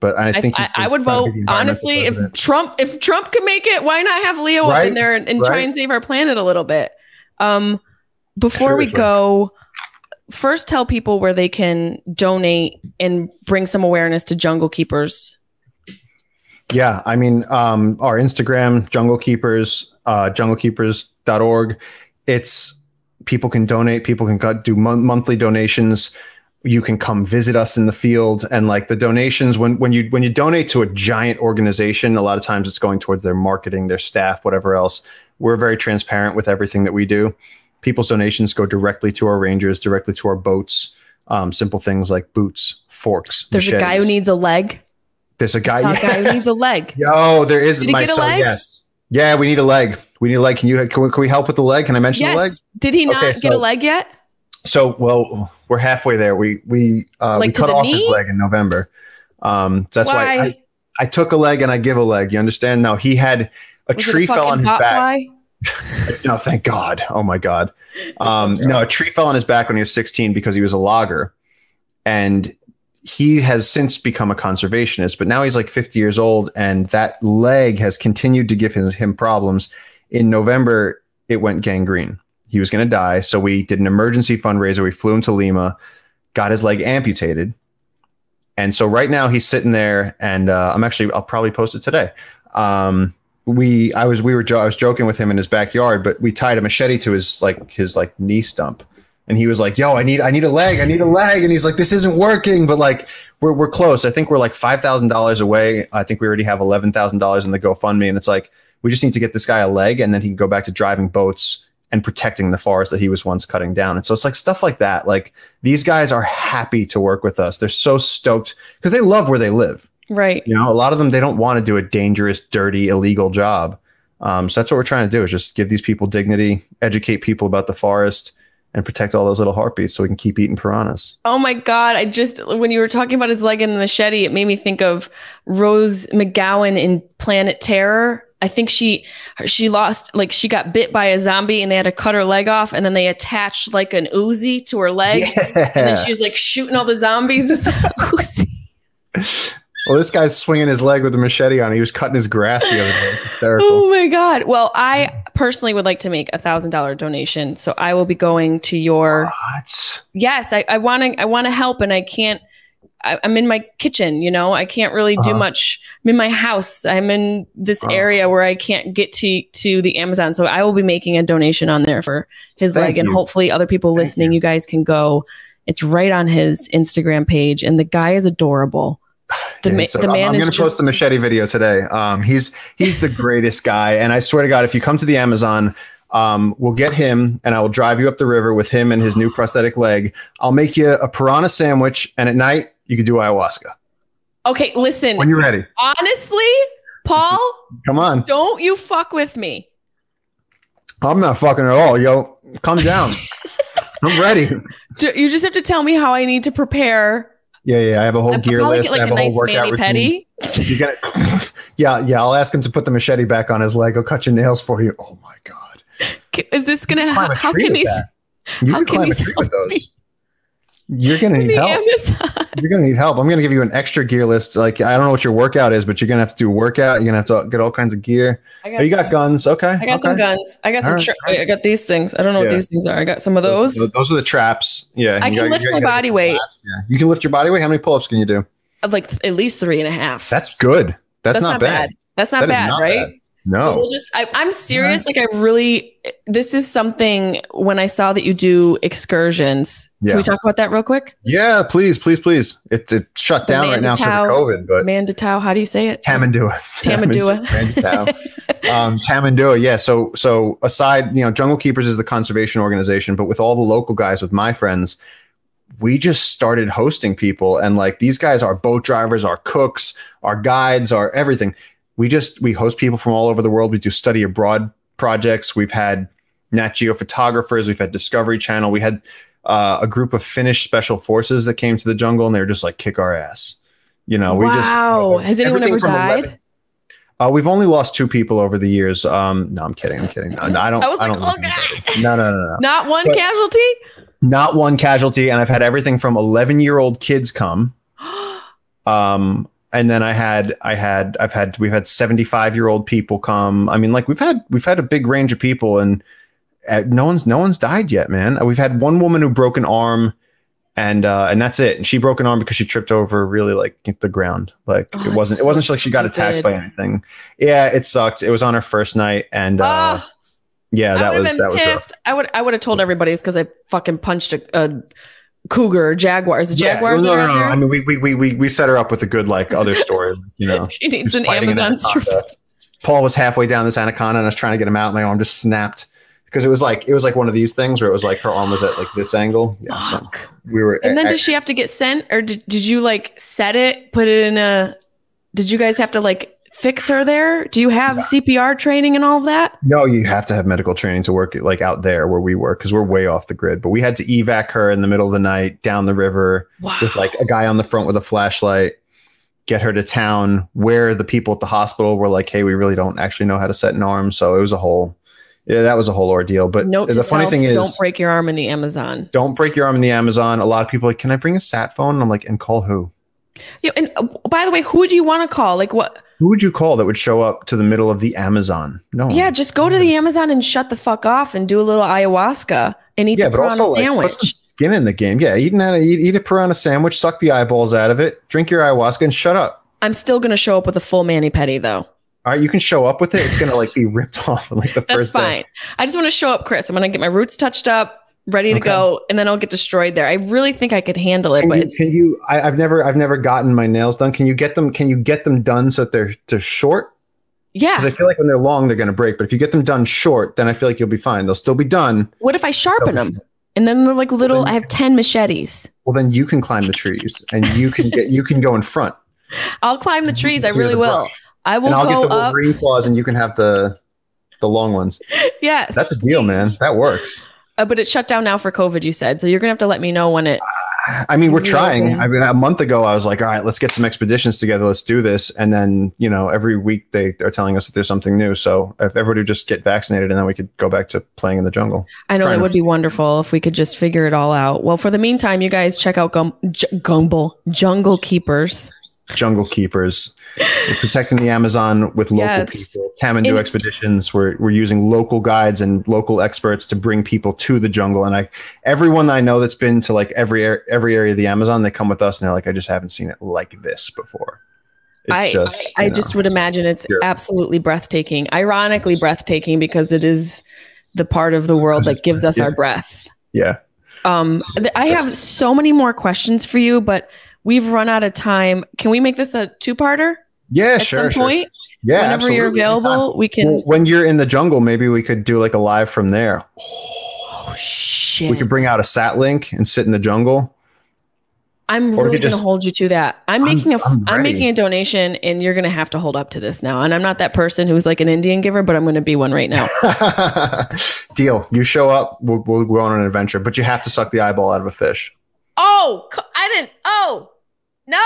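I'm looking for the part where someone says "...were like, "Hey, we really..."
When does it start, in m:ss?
6:01.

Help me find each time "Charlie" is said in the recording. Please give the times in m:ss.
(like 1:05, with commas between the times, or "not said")
not said.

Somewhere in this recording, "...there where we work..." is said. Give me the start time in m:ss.
5:51.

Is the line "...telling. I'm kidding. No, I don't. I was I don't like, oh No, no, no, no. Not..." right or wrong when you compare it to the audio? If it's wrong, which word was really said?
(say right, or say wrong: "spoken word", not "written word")
wrong: "kidding", not "telling".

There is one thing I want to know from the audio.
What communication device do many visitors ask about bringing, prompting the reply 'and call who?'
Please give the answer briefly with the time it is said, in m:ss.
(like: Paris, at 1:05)
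Sat phone, at 6:11.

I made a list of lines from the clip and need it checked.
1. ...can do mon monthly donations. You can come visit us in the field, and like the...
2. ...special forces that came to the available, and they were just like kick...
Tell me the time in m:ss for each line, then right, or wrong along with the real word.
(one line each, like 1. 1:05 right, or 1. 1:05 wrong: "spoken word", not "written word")
1. 0:24 right
2. 4:40 wrong: "jungle", not "available".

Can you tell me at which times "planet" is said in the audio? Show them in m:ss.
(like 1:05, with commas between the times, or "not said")
0:05, 2:17.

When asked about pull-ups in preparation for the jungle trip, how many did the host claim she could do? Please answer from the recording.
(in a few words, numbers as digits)
3 and a half.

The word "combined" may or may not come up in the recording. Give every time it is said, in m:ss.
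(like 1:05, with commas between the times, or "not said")
not said.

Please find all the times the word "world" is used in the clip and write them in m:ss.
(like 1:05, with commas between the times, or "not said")
4:33, 7:51.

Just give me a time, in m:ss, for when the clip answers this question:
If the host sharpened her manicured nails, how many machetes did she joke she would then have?
6:54.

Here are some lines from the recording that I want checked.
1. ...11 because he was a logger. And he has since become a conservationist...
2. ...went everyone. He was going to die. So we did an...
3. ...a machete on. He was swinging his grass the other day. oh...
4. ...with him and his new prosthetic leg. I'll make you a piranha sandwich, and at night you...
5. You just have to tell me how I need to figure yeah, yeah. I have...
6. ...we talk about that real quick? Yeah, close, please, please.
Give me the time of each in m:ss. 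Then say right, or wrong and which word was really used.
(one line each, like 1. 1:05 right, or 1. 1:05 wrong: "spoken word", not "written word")
1. 1:09 wrong: "16", not "11"
2. 1:21 wrong: "gangrene", not "everyone"
3. 2:31 wrong: "cutting", not "swinging"
4. 3:08 right
5. 3:25 wrong: "prepare", not "figure"
6. 4:10 wrong: "please", not "close".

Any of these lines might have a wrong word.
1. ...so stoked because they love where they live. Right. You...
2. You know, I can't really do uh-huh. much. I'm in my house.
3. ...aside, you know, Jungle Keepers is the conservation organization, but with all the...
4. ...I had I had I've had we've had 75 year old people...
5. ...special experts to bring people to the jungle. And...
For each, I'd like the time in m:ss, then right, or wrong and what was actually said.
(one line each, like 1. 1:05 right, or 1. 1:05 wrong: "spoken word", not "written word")
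1. 1:57 right
2. 2:44 right
3. 4:20 right
4. 5:00 right
5. 7:35 wrong: "local", not "special".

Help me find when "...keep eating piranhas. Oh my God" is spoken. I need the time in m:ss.
2:10.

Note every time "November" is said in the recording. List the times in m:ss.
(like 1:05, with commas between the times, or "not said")
0:58, 1:20.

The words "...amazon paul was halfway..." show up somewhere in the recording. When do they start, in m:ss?
5:31.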